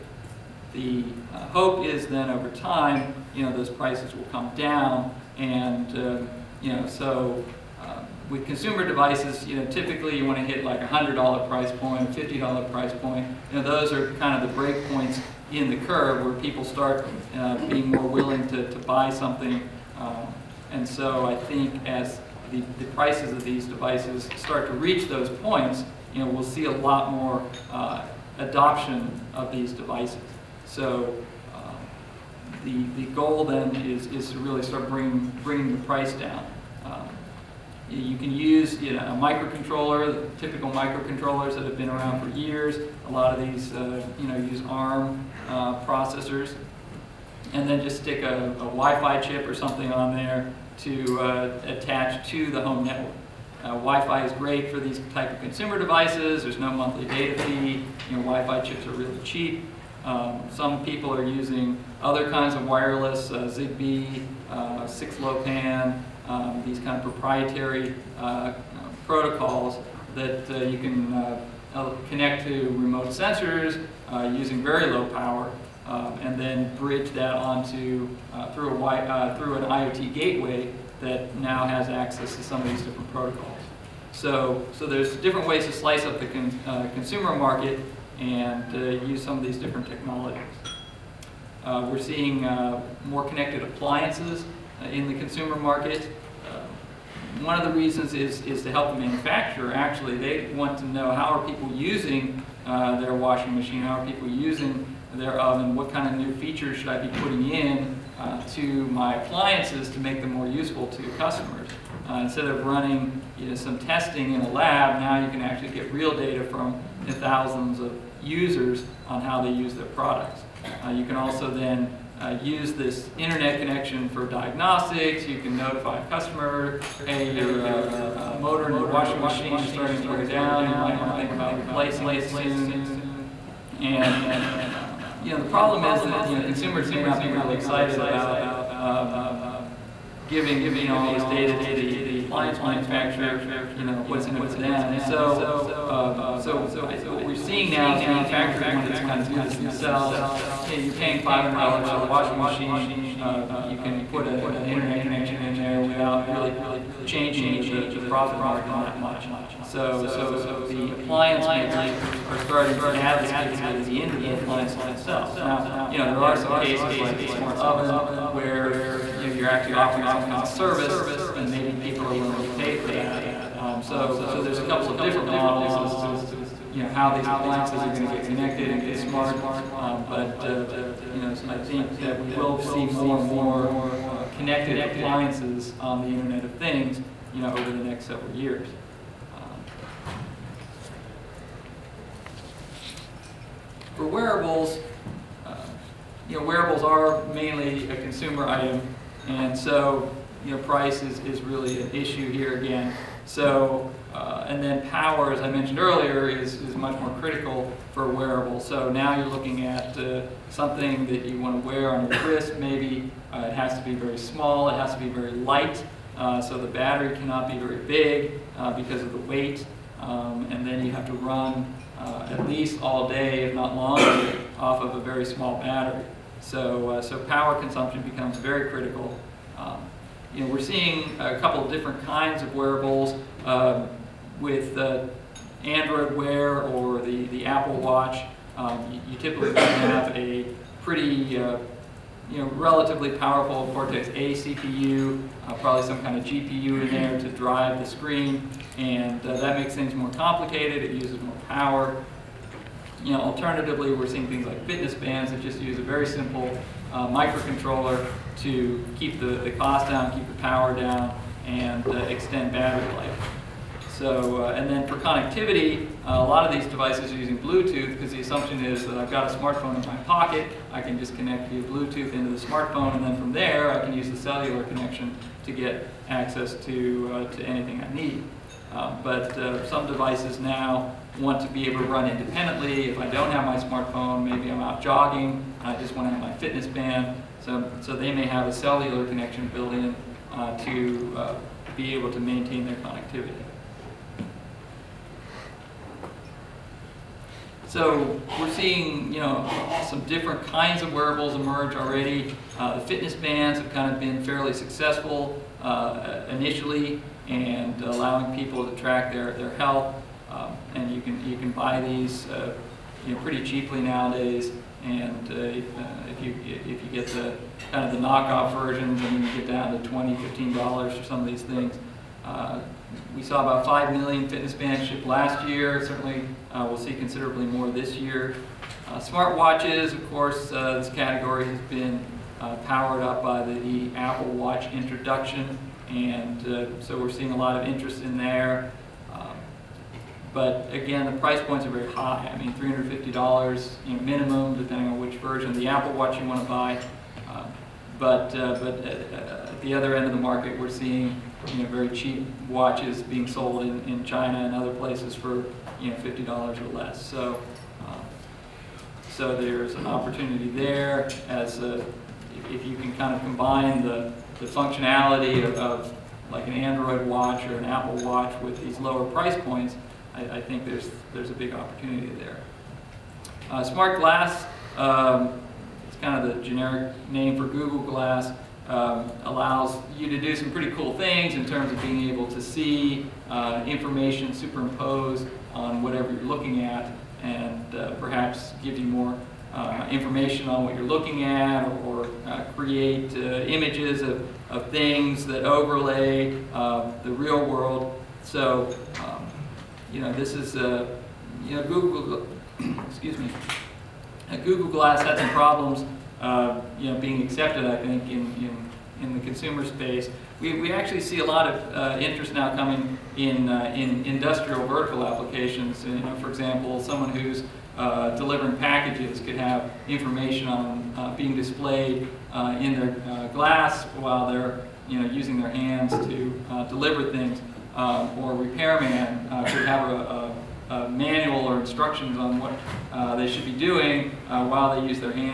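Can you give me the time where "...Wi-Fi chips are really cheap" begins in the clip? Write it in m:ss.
0:58.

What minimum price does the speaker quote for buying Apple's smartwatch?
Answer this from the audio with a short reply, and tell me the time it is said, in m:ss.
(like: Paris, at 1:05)
$350, at 5:42.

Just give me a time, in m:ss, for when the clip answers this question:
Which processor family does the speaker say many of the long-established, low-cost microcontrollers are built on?
0:44.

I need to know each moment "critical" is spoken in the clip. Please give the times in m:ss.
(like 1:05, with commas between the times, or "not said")
3:27, 3:48.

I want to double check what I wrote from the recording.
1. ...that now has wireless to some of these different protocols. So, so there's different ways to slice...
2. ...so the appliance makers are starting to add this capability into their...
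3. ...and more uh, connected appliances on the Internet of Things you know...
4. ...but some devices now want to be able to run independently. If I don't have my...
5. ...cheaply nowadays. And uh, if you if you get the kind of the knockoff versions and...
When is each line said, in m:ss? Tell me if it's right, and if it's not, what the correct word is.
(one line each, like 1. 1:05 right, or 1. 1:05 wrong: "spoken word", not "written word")
1. 1:21 wrong: "access", not "wireless"
2. 2:40 right
3. 3:03 right
4. 4:39 right
5. 5:13 right.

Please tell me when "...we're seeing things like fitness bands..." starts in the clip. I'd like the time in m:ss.
4:13.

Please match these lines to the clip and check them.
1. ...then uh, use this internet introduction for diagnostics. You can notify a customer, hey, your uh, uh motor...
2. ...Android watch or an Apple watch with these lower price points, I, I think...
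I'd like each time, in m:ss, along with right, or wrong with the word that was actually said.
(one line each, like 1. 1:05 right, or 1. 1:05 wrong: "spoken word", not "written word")
1. 2:01 wrong: "connection", not "introduction"
2. 6:06 right.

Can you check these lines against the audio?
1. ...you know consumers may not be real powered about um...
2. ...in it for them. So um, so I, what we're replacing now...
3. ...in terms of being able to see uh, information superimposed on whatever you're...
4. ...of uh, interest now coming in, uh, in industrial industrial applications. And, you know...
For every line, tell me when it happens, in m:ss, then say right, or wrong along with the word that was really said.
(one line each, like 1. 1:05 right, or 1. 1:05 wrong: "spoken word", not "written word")
1. 2:16 wrong: "excited", not "powered"
2. 2:24 wrong: "seeing", not "replacing"
3. 6:21 right
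4. 6:51 wrong: "vertical", not "industrial".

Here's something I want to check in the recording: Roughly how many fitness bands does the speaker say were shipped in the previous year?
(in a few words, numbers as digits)
5 million.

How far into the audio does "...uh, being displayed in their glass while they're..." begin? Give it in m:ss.
7:00.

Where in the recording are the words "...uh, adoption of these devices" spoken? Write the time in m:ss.
0:27.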